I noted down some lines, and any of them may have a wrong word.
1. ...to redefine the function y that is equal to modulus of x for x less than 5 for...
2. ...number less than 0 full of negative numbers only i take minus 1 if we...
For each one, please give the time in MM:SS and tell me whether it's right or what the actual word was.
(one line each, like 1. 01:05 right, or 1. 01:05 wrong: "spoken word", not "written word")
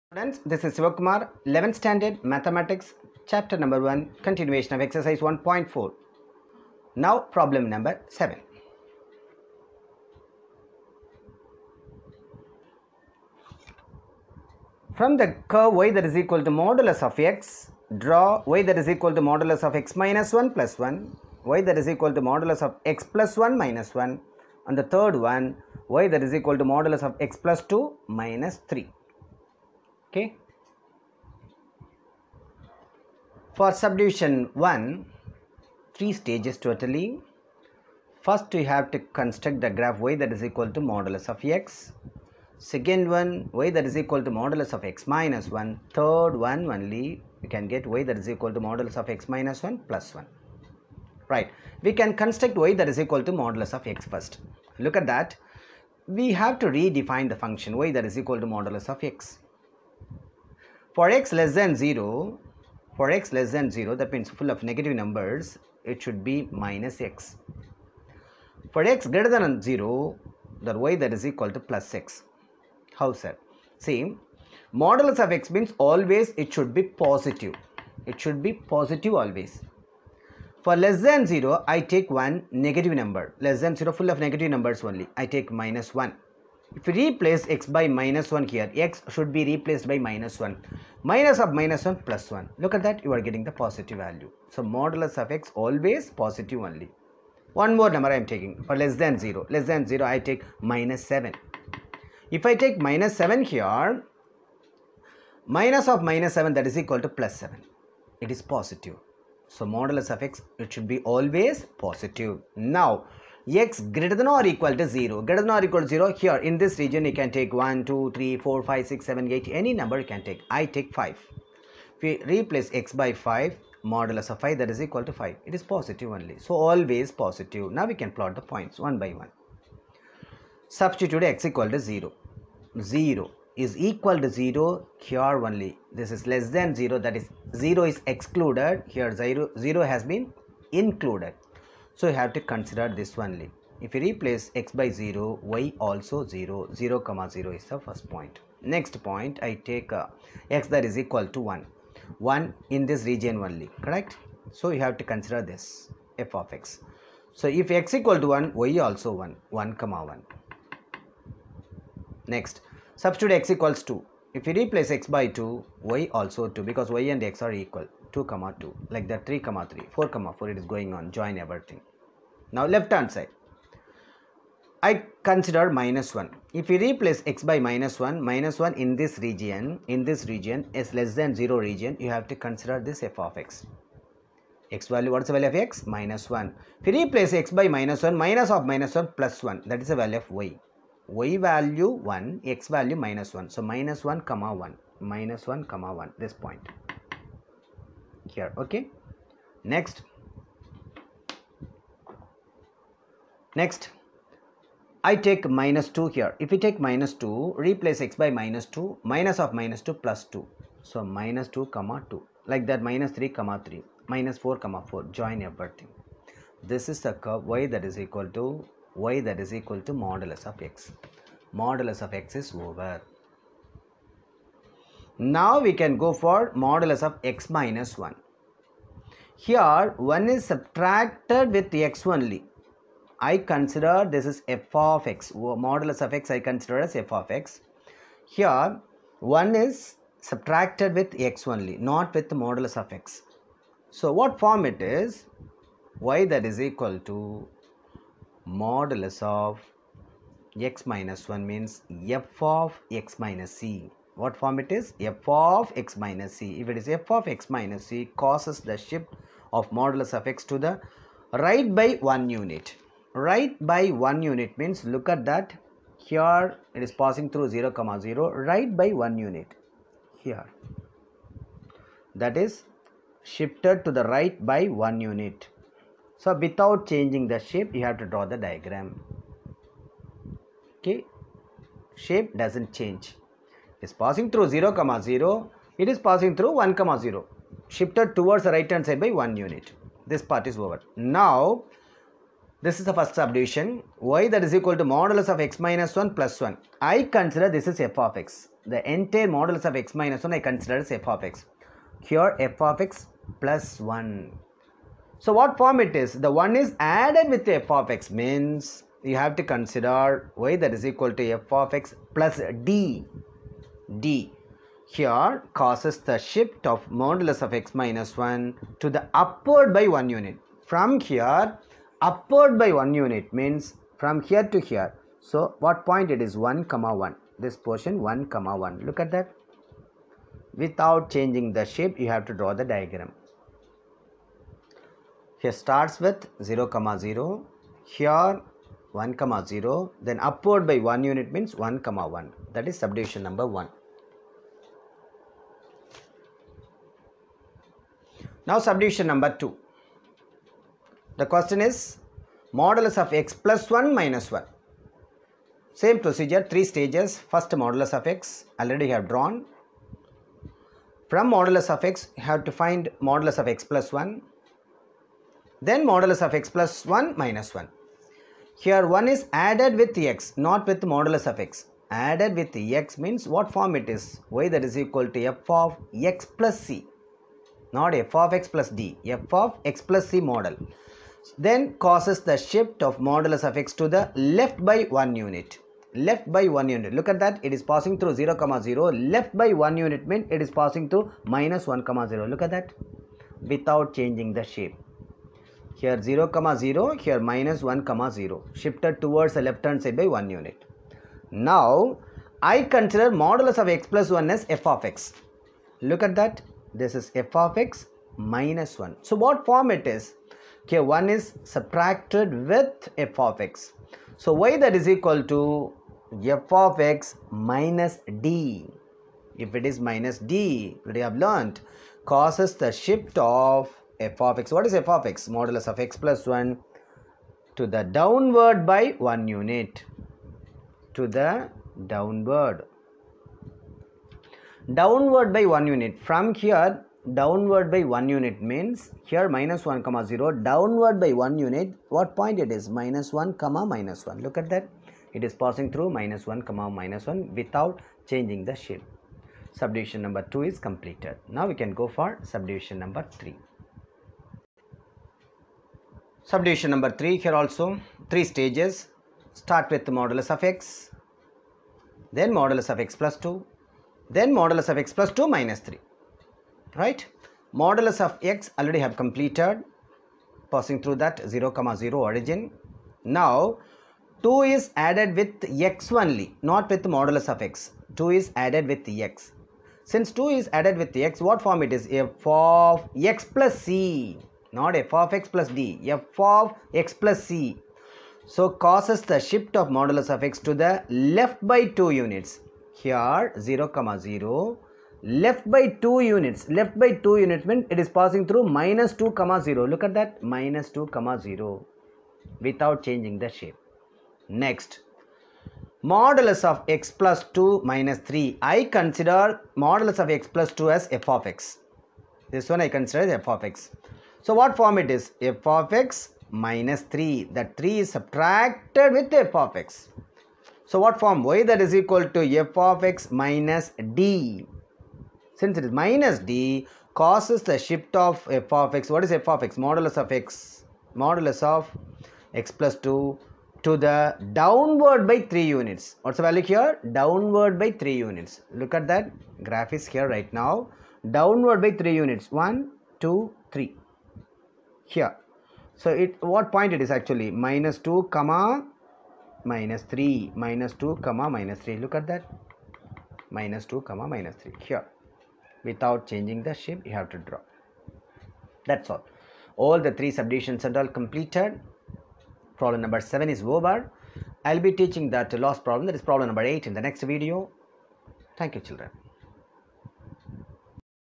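1. 00:56 wrong: "0", not "5"
2. 01:23 right.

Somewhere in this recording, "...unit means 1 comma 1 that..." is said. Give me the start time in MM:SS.
05:41.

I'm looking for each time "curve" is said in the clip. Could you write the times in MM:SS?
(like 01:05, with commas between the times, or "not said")
00:15, 03:37.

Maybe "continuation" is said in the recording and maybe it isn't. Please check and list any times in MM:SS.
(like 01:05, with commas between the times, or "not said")
00:04.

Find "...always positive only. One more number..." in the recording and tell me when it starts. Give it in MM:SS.
01:35.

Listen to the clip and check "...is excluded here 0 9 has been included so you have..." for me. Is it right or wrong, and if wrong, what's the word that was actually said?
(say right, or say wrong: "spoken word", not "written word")
wrong: "0", not "9".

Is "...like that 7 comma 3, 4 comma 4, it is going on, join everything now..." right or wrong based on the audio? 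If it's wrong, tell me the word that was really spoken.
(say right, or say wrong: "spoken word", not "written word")
wrong: "3", not "7".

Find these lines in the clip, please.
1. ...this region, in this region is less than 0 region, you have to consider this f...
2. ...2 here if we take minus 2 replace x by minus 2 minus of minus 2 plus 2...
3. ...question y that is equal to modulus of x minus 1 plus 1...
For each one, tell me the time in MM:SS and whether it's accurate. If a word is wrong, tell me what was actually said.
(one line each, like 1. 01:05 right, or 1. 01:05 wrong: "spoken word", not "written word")
1. 02:58 right
2. 03:25 right
3. 04:53 wrong: "subdivision", not "question".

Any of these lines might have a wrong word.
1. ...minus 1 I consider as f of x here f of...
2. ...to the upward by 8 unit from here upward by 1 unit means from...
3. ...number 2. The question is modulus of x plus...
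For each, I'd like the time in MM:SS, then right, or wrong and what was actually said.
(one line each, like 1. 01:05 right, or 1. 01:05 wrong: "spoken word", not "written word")
1. 05:00 right
2. 05:18 wrong: "1", not "8"
3. 05:49 right.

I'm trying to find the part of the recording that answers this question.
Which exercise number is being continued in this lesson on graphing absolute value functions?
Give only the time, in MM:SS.
00:04.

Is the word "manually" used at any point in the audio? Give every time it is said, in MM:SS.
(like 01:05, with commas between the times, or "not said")
not said.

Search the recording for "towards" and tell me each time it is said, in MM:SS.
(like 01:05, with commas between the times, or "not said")
04:48, 06:39.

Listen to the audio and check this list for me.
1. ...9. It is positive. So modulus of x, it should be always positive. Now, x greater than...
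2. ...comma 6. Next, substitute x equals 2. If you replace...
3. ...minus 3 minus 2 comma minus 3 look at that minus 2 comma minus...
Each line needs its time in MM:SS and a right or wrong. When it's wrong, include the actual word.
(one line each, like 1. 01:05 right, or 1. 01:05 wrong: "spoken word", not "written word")
1. 01:47 wrong: "7", not "9"
2. 02:39 wrong: "1", not "6"
3. 09:09 right.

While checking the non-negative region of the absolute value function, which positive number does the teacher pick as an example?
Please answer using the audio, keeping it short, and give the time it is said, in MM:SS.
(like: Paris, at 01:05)
5, at 02:00.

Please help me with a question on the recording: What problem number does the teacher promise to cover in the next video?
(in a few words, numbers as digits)
8.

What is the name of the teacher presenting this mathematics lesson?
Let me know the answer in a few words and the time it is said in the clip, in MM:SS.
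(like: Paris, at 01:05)
Sivakumar, at 00:00.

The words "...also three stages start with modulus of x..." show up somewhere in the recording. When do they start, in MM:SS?
07:37.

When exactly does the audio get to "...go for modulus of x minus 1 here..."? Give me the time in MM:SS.
03:46.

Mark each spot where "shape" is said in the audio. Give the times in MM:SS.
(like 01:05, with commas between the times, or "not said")
04:37, 04:41, 05:31, 06:34, 07:28, 08:23, 09:16.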